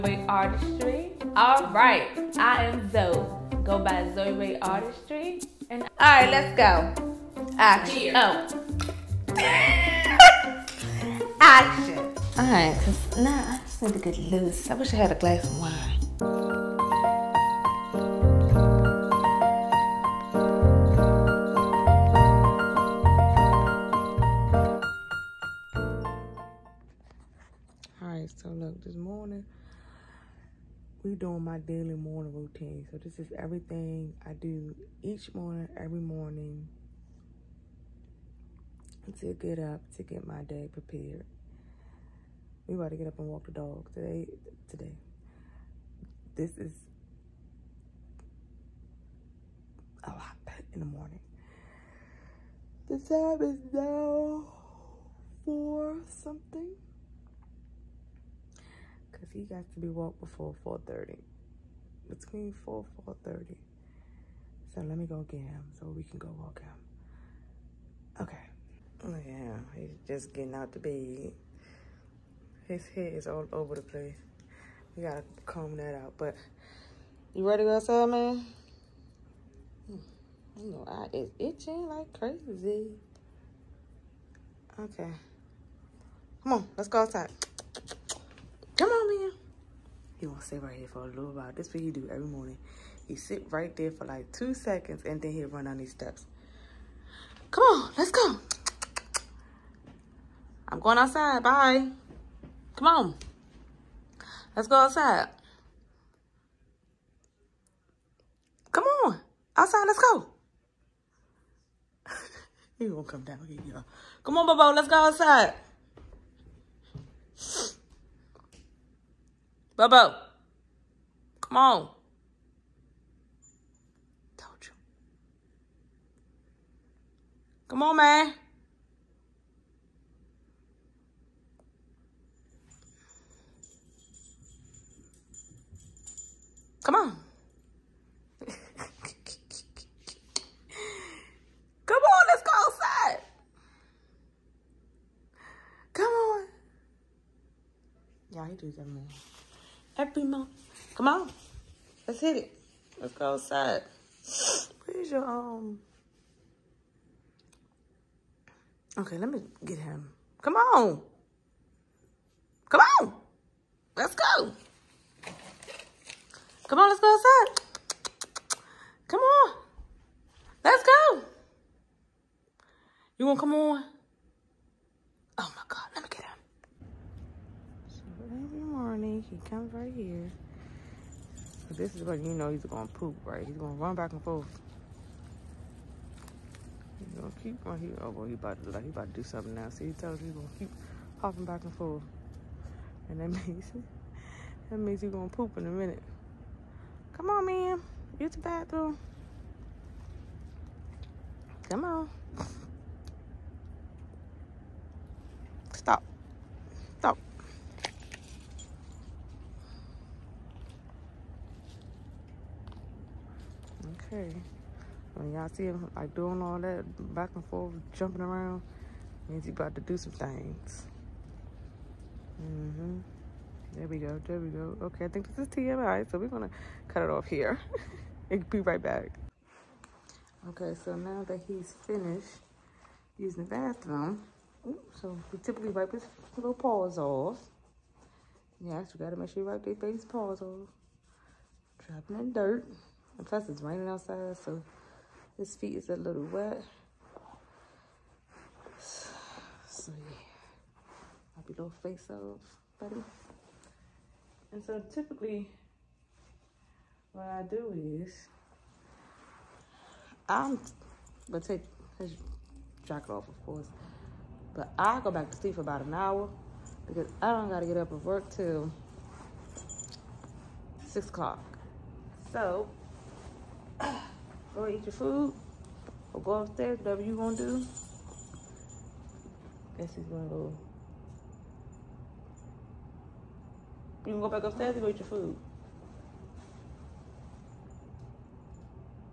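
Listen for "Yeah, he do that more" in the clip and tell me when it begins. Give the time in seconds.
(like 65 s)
148 s.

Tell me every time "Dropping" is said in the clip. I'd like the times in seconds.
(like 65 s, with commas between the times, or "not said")
241 s.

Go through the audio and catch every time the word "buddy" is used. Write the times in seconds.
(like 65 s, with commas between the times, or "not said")
252 s.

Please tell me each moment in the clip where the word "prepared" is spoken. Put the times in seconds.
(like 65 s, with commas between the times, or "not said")
40 s.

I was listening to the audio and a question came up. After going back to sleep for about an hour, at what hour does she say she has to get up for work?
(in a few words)
6 o'clock.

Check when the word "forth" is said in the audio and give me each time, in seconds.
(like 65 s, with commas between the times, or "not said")
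184 s, 191 s, 217 s.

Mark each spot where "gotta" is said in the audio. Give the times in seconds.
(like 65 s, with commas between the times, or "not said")
75 s, 239 s, 267 s.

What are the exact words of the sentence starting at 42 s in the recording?
We about to get up and walk the dog today.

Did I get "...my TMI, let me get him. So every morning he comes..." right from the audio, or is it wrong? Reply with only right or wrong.
wrong.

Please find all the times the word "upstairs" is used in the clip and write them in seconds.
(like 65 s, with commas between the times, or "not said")
276 s, 284 s.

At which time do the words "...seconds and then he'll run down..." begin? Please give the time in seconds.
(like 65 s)
94 s.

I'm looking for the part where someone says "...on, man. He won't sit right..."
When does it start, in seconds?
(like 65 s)
88 s.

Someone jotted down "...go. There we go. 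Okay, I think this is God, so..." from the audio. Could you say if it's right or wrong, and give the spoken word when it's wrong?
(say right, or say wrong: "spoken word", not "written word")
wrong: "TMI", not "God".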